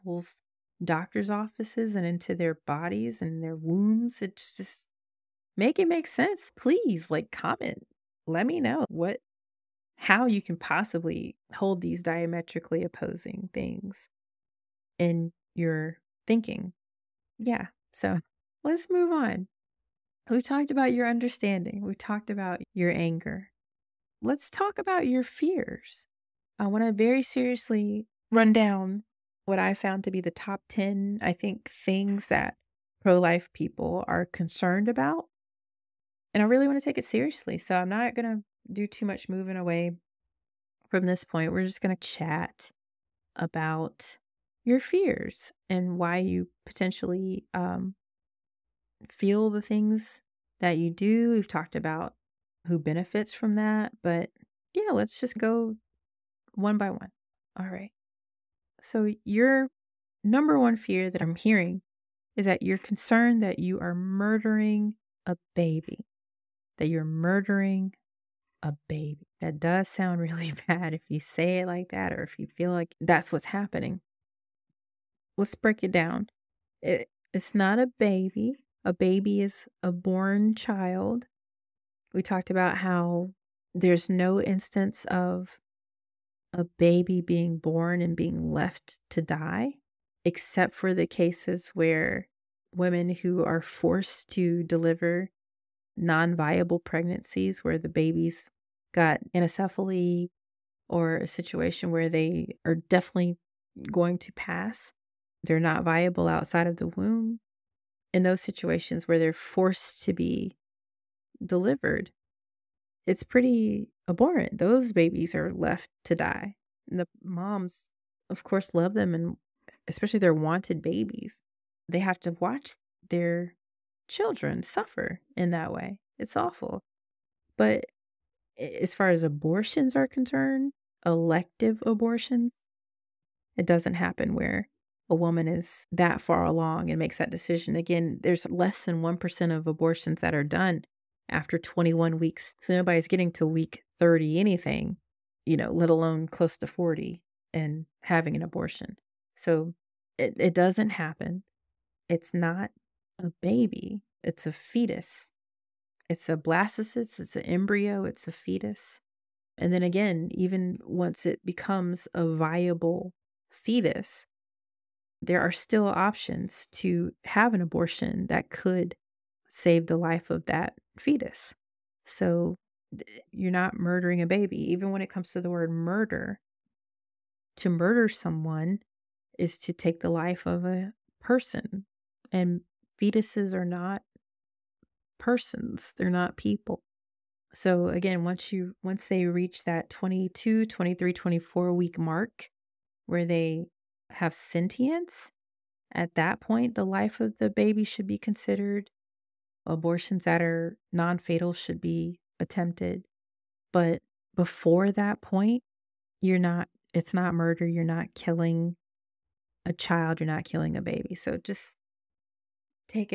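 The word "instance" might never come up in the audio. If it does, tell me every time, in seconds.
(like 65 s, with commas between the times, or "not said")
84 s.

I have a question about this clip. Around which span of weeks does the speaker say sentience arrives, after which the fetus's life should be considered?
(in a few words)
22 to 24 weeks.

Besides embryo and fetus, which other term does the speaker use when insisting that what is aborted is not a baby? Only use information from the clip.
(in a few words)
blastocyst.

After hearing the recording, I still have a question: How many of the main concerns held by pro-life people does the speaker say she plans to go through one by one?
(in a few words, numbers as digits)
10.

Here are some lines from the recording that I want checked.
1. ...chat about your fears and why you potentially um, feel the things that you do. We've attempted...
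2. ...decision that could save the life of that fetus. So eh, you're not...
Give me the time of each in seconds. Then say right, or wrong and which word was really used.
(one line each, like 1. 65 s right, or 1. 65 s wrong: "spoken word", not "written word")
1. 42 s wrong: "talked", not "attempted"
2. 167 s wrong: "abortion", not "decision".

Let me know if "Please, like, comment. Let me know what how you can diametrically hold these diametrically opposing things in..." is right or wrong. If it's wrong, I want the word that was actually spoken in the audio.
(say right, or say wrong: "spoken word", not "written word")
wrong: "possibly", not "diametrically".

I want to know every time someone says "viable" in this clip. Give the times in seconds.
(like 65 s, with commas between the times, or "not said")
96 s, 105 s, 162 s.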